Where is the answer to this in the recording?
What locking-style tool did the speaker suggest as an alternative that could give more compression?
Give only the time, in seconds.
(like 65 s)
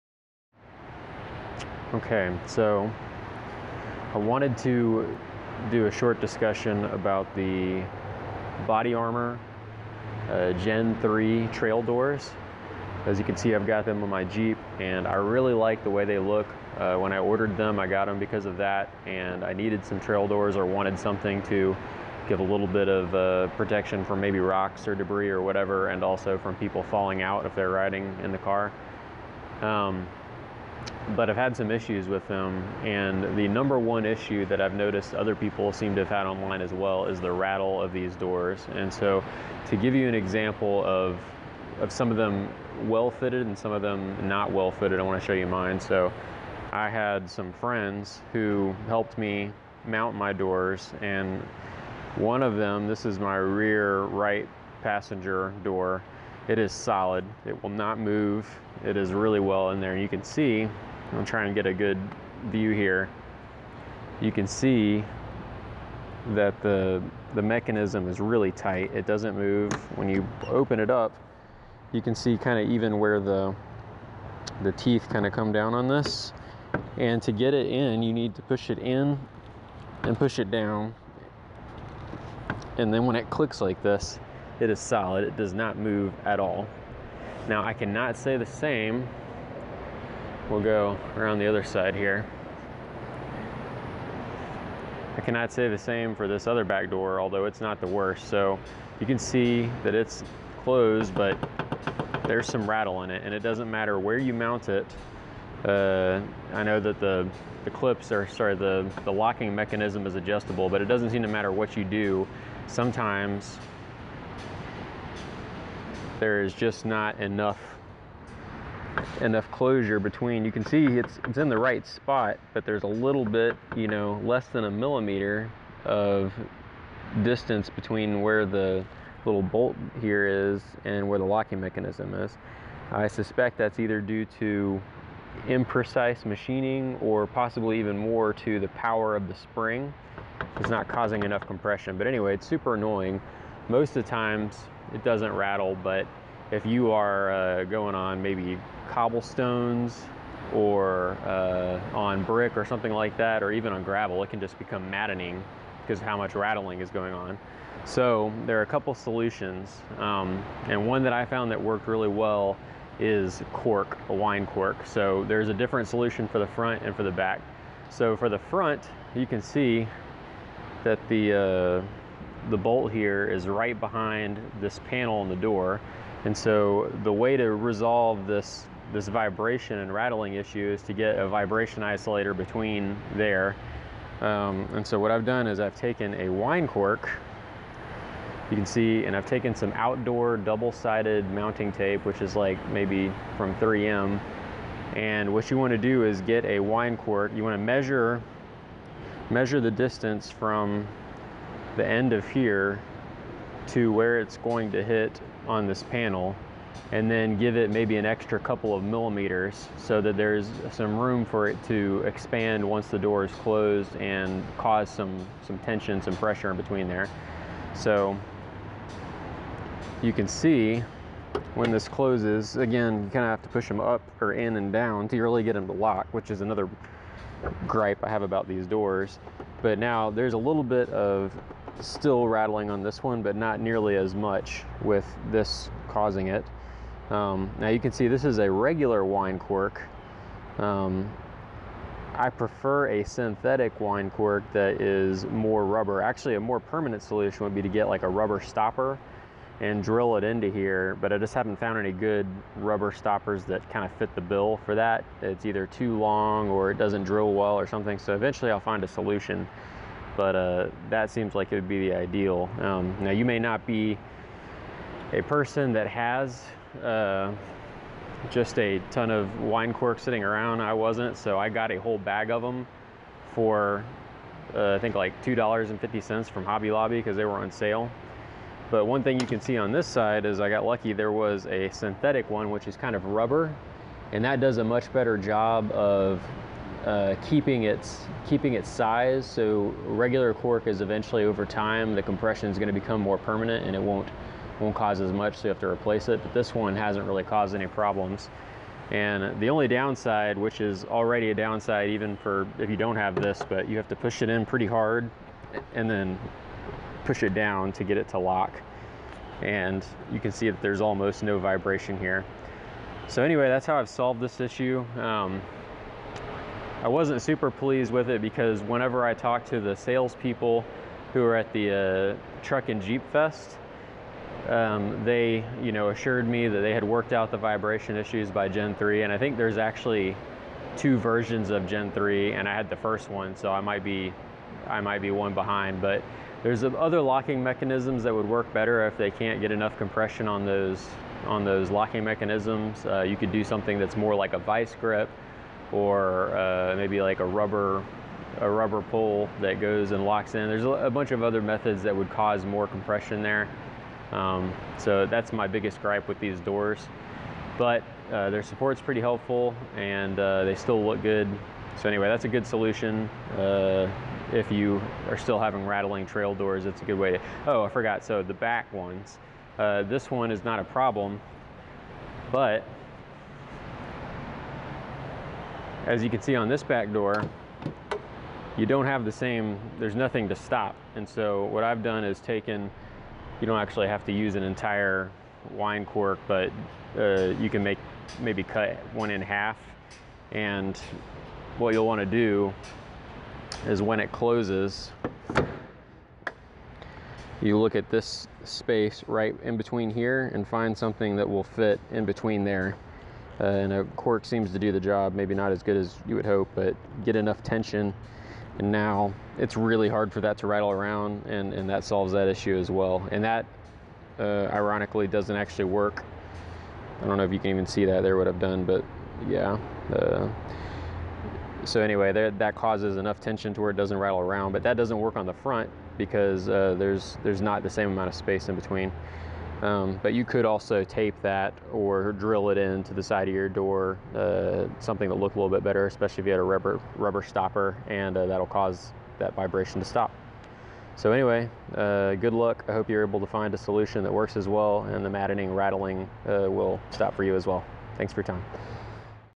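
344 s.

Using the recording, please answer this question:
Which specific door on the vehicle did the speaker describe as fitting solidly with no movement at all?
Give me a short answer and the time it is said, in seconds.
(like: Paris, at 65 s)
Rear right passenger door, at 53 s.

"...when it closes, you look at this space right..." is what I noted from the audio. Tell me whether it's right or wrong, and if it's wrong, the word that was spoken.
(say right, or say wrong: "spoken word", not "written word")
right.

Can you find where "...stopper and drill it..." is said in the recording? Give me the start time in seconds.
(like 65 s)
248 s.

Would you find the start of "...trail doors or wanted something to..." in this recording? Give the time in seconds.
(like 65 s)
19 s.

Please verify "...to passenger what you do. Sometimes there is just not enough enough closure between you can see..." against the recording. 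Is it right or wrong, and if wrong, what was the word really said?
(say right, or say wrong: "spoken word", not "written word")
wrong: "matter", not "passenger".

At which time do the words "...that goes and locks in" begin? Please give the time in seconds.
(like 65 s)
349 s.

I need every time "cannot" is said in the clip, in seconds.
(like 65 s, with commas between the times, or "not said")
87 s, 95 s.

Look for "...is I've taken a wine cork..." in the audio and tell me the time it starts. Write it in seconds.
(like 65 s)
185 s.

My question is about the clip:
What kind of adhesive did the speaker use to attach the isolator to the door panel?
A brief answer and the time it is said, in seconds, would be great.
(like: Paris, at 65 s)
Outdoor double-sided mounting tape, at 189 s.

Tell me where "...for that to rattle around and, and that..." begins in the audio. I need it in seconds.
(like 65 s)
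410 s.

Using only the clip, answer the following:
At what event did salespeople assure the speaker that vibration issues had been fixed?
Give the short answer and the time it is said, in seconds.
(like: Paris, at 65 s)
Truck and Jeep Fest, at 322 s.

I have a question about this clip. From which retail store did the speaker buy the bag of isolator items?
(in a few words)
Hobby Lobby.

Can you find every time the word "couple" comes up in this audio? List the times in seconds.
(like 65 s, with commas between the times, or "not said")
158 s, 208 s.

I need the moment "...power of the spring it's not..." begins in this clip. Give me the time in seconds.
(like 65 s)
138 s.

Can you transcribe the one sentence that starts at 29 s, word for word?
Um, but I've had some issues with them.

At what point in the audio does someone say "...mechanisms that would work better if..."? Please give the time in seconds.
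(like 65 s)
337 s.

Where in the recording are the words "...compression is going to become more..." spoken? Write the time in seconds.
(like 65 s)
292 s.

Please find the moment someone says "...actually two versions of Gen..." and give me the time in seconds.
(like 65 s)
329 s.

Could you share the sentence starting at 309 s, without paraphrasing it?
And you can see that there's almost no vibration here.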